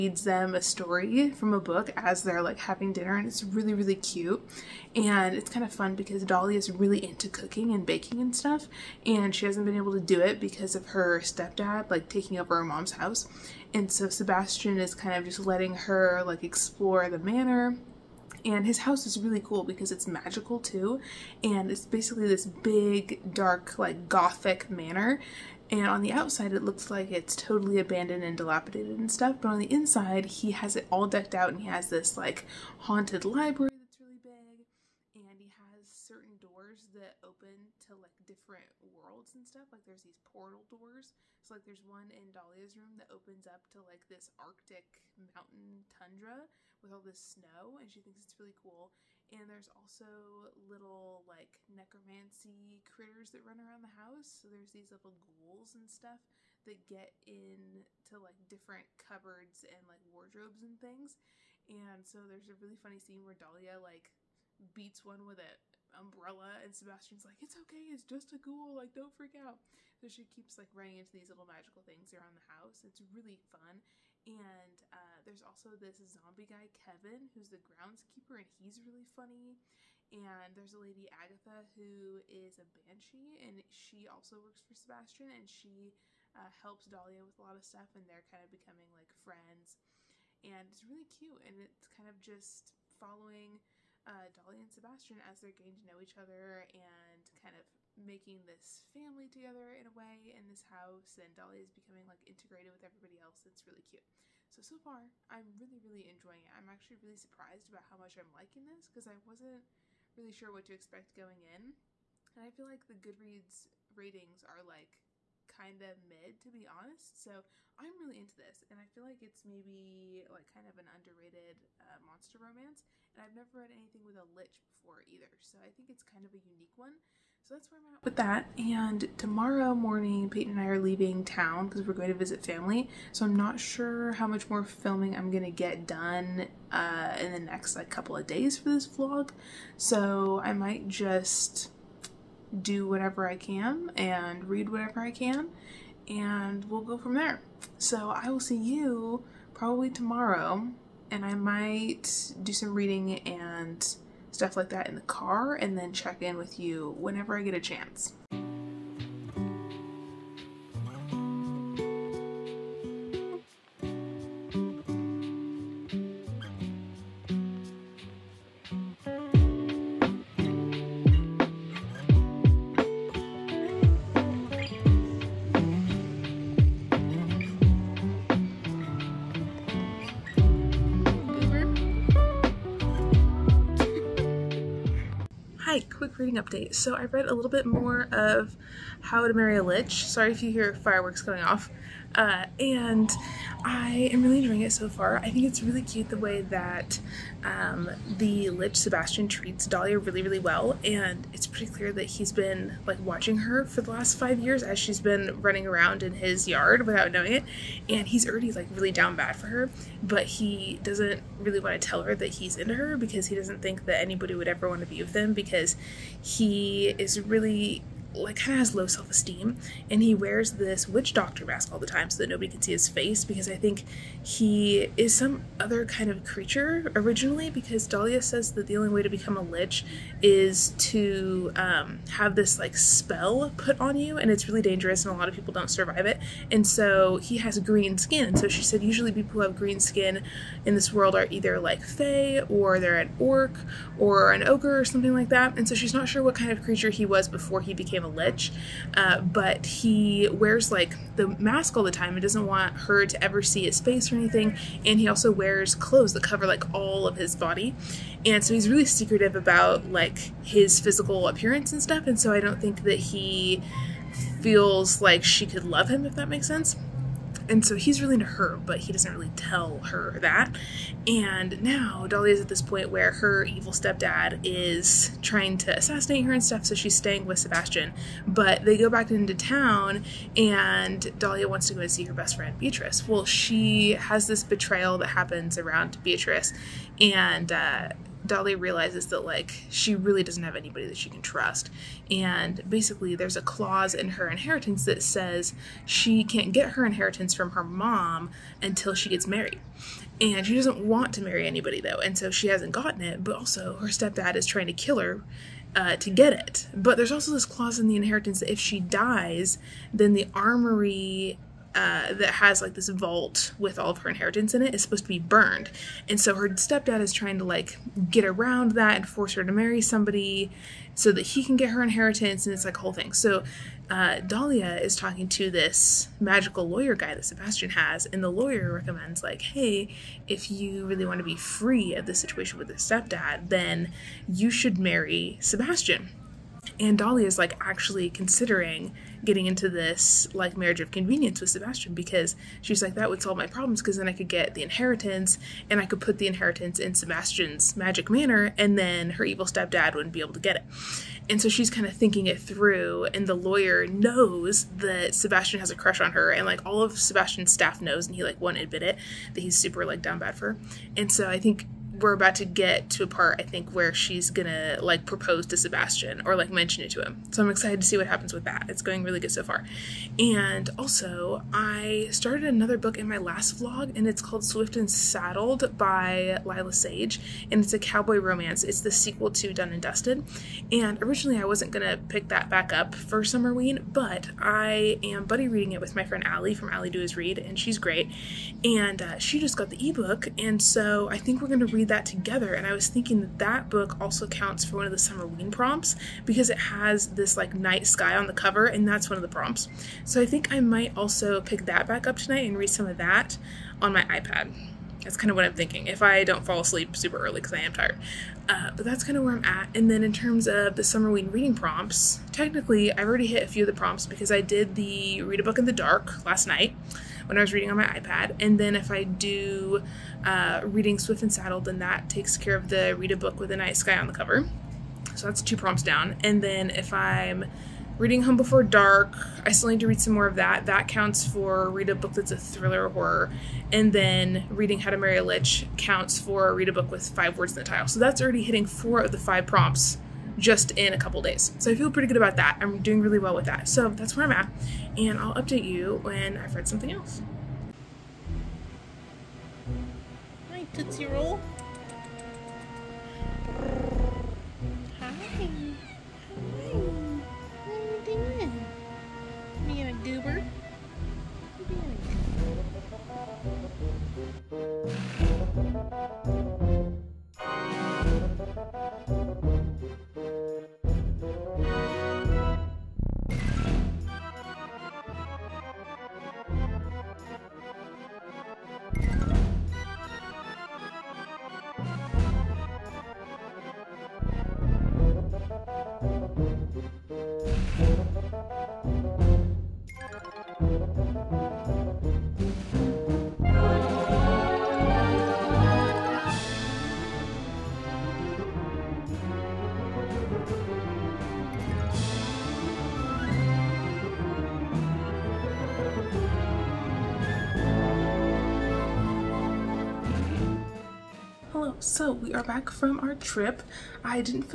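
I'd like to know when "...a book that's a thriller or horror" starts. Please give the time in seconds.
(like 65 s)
431 s.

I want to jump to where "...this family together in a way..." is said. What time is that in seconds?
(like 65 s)
98 s.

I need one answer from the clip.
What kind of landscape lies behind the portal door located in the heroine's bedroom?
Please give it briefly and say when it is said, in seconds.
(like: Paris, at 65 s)
Arctic mountain tundra, at 44 s.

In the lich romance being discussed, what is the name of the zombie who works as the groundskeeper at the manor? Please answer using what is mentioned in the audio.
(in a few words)
Kevin.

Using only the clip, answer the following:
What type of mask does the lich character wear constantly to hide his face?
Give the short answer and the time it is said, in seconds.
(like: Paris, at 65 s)
Witch doctor mask, at 220 s.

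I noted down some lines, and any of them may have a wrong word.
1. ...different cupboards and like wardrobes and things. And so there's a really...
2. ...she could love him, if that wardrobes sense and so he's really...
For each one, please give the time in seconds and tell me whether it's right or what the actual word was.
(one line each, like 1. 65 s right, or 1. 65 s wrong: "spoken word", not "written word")
1. 58 s right
2. 265 s wrong: "makes", not "wardrobes".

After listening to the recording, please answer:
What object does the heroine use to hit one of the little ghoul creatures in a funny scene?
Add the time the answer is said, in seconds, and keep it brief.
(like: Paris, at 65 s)
An umbrella, at 65 s.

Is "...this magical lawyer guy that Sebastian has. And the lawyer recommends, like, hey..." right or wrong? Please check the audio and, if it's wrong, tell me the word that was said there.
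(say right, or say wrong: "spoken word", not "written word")
right.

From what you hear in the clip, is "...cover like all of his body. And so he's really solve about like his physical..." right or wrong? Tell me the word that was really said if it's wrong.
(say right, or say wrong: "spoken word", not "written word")
wrong: "secretive", not "solve".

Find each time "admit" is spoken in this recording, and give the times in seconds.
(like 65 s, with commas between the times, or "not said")
358 s.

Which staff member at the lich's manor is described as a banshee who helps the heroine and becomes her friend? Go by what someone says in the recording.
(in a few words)
Agatha.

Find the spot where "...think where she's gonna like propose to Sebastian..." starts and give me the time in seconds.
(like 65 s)
363 s.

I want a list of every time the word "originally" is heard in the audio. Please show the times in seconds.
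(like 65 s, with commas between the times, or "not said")
226 s, 381 s.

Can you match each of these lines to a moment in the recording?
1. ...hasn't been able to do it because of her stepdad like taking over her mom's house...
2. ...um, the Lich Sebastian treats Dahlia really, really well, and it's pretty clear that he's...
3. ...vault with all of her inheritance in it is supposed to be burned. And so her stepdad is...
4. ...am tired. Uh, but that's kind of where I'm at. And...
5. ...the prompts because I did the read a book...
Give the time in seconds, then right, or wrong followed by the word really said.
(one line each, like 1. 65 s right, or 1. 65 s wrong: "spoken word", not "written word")
1. 9 s right
2. 197 s right
3. 312 s right
4. 407 s right
5. 413 s right.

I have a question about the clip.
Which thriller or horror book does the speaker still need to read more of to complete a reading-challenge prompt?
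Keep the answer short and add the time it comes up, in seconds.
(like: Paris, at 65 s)
Home Before Dark, at 428 s.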